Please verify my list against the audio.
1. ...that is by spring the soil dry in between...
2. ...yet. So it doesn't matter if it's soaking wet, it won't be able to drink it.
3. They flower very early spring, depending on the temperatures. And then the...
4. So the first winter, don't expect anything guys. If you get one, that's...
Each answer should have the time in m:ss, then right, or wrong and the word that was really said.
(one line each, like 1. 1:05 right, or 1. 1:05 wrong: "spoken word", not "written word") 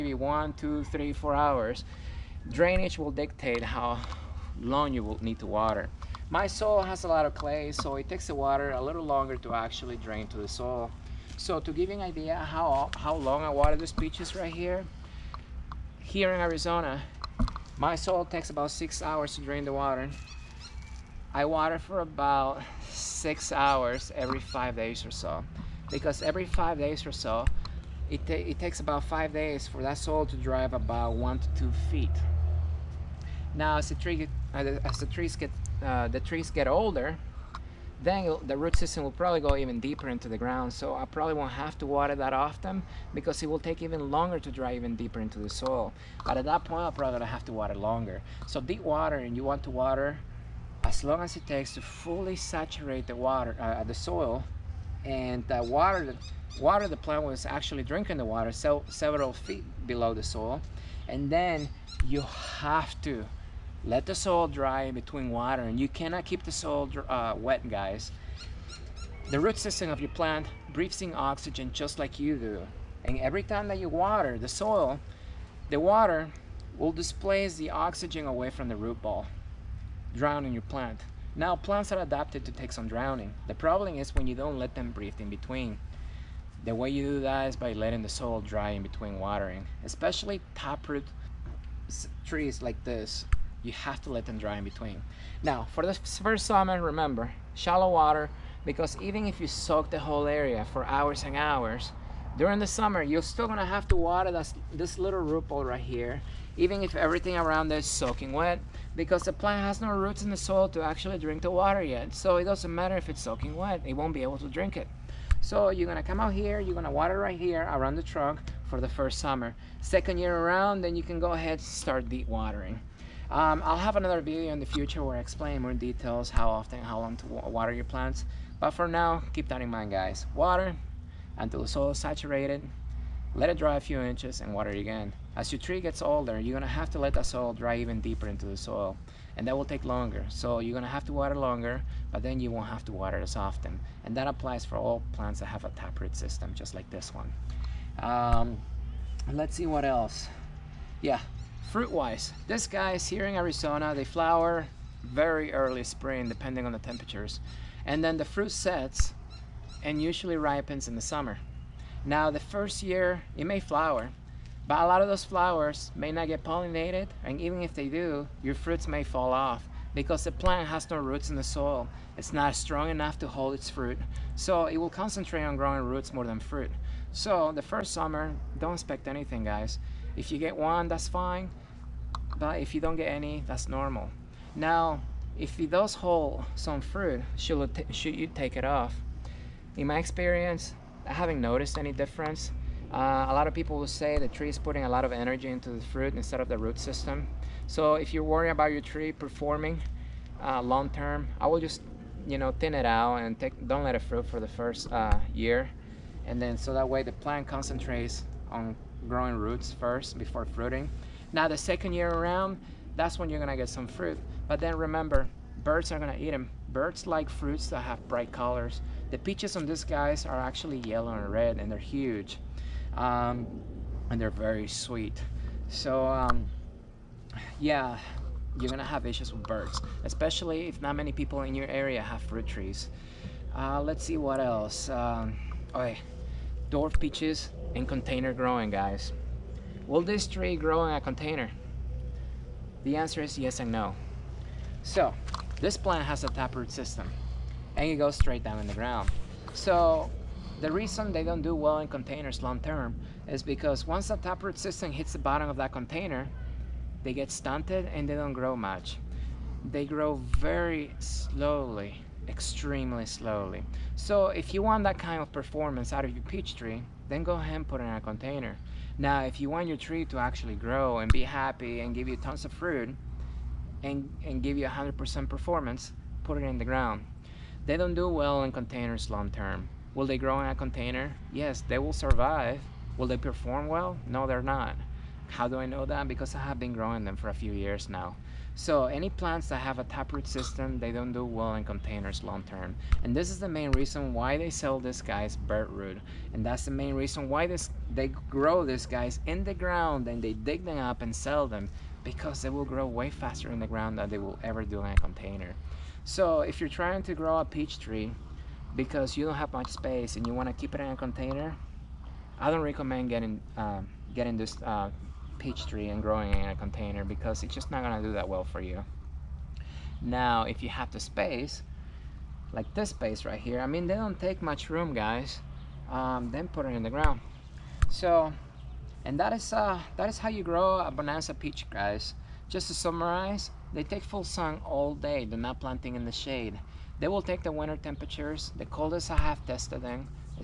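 1. 1:27 wrong: "letting", not "spring"
2. 1:51 right
3. 2:33 right
4. 2:57 wrong: "summer", not "winter".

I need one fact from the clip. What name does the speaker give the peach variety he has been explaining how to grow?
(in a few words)
bonanza peach.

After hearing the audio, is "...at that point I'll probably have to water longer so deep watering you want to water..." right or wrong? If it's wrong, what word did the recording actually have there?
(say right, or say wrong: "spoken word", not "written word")
right.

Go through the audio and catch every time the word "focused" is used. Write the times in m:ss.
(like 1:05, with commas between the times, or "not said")
not said.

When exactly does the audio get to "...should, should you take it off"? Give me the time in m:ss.
3:07.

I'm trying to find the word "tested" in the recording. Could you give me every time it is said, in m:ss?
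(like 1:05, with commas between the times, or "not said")
5:39.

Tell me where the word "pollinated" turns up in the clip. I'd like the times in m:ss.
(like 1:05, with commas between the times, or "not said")
2:46.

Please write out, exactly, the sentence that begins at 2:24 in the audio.
And that applies for all plants that have a taproot system, just like this one.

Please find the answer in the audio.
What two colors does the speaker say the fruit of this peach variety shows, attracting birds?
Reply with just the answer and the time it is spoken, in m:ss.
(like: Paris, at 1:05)
yellow and red, at 3:40.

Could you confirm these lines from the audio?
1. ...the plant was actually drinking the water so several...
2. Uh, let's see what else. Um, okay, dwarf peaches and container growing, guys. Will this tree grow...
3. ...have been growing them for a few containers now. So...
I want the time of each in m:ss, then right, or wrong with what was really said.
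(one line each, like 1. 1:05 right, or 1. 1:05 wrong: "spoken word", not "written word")
1. 0:56 right
2. 3:53 right
3. 4:46 wrong: "years", not "containers".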